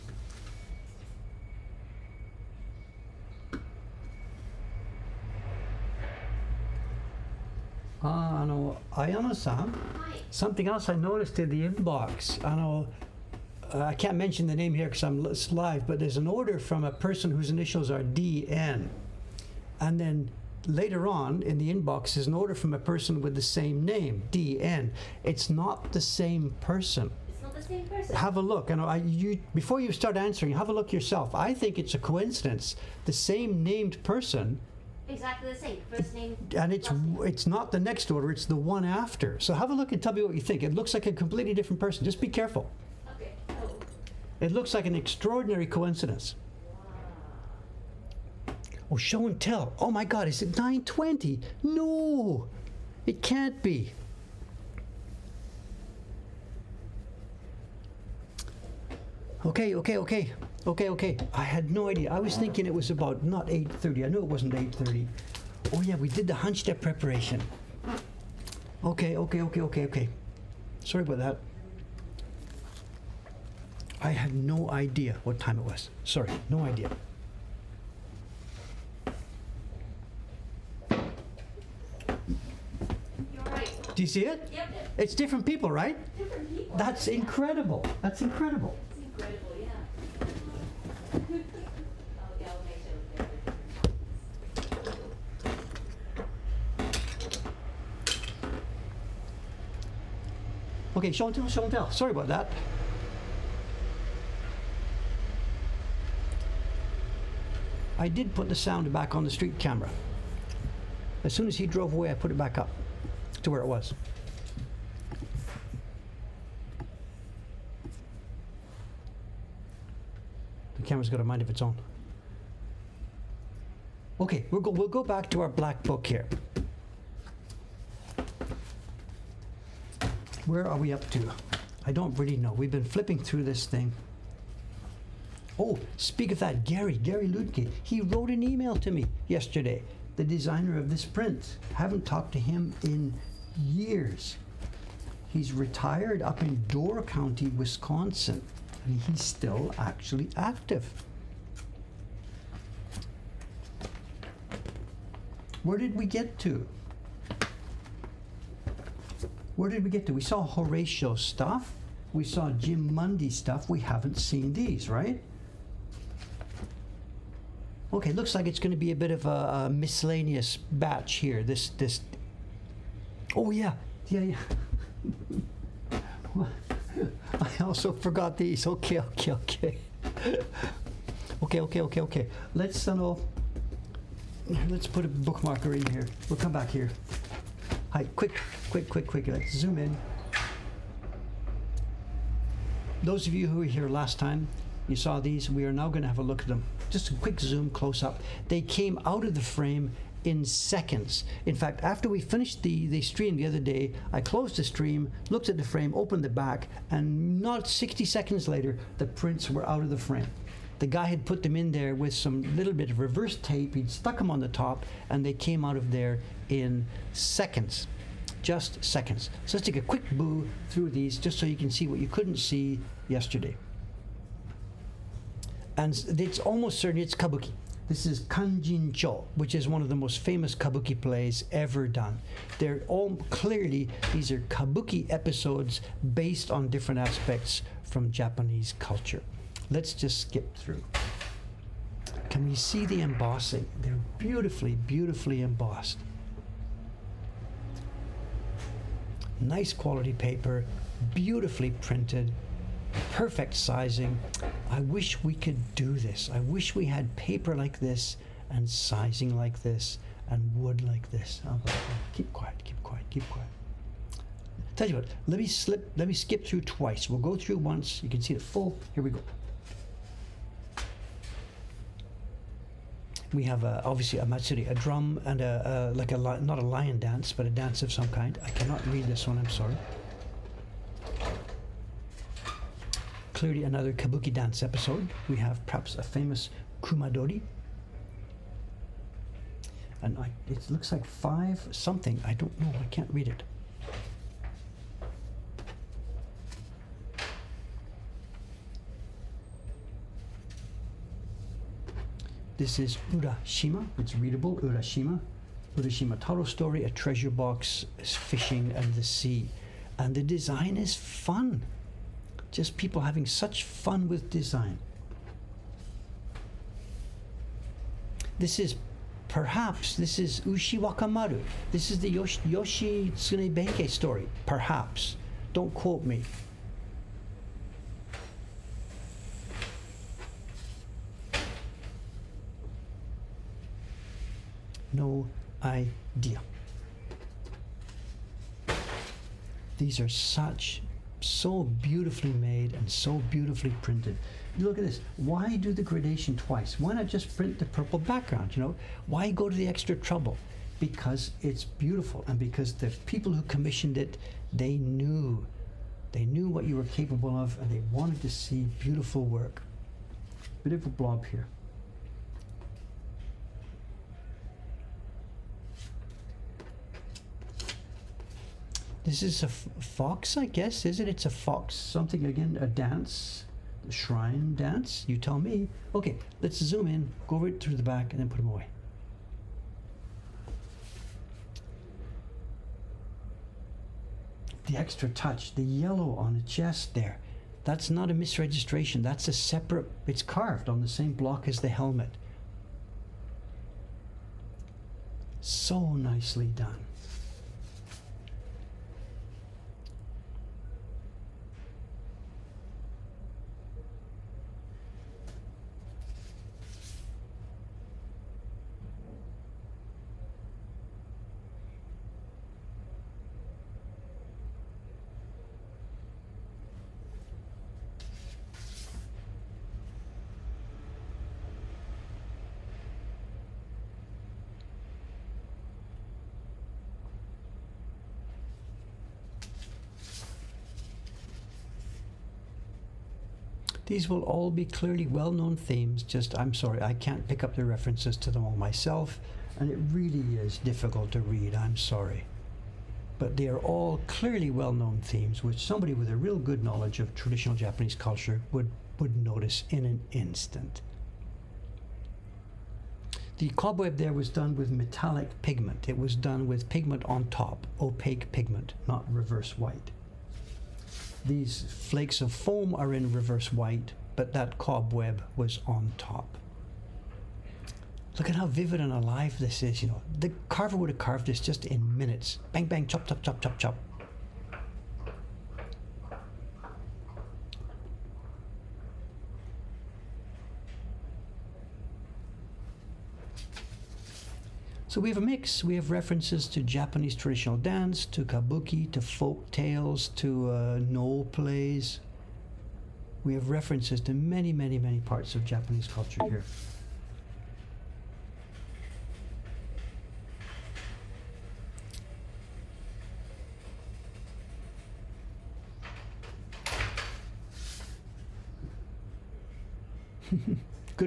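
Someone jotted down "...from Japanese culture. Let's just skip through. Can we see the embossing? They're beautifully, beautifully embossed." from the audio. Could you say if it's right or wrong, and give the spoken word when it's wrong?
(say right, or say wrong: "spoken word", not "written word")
right.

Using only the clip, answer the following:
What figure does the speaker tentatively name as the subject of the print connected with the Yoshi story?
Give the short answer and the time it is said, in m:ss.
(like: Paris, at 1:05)
Ushi Wakamaru, at 5:20.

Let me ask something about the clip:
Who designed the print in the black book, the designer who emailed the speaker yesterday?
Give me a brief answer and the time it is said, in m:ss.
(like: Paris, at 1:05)
Gary Ludke, at 2:16.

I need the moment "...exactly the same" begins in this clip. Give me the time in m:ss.
0:35.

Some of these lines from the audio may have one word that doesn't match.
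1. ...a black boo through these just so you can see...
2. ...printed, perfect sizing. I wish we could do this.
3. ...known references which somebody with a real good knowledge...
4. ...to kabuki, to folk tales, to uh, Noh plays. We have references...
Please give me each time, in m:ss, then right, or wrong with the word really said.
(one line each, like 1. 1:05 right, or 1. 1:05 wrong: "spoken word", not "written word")
1. 3:39 wrong: "quick", not "black"
2. 4:11 right
3. 7:24 wrong: "themes", not "references"
4. 8:08 right.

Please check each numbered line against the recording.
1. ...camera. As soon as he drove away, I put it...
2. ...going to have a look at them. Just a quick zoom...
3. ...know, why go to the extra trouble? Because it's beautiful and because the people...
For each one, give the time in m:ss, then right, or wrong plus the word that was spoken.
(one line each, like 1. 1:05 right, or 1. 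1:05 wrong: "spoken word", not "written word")
1. 1:49 right
2. 3:15 right
3. 5:48 right.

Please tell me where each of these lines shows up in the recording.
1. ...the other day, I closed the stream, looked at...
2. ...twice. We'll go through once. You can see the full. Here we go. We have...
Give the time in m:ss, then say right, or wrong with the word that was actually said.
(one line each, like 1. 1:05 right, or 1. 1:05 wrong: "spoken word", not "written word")
1. 3:23 right
2. 4:26 right.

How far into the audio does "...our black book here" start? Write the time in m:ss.
2:05.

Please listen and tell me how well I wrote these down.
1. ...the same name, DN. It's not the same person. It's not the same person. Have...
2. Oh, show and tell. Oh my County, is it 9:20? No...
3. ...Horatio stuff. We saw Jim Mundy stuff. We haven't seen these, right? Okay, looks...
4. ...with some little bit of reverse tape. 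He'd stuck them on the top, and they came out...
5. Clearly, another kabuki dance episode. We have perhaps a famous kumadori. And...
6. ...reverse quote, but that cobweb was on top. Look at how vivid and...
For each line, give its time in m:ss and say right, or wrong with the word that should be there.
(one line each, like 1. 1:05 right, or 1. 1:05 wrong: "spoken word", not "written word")
1. 0:23 right
2. 0:48 wrong: "God", not "County"
3. 2:40 right
4. 3:31 right
5. 4:43 right
6. 7:43 wrong: "white", not "quote".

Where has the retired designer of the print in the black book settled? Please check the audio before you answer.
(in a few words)
Door County, Wisconsin.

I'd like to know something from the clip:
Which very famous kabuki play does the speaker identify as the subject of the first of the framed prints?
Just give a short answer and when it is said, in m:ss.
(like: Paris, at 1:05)
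Kanjin Cho, at 3:48.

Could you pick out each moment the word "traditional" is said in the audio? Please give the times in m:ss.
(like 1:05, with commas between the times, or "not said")
7:27, 8:07.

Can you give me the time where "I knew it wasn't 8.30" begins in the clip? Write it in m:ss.
1:04.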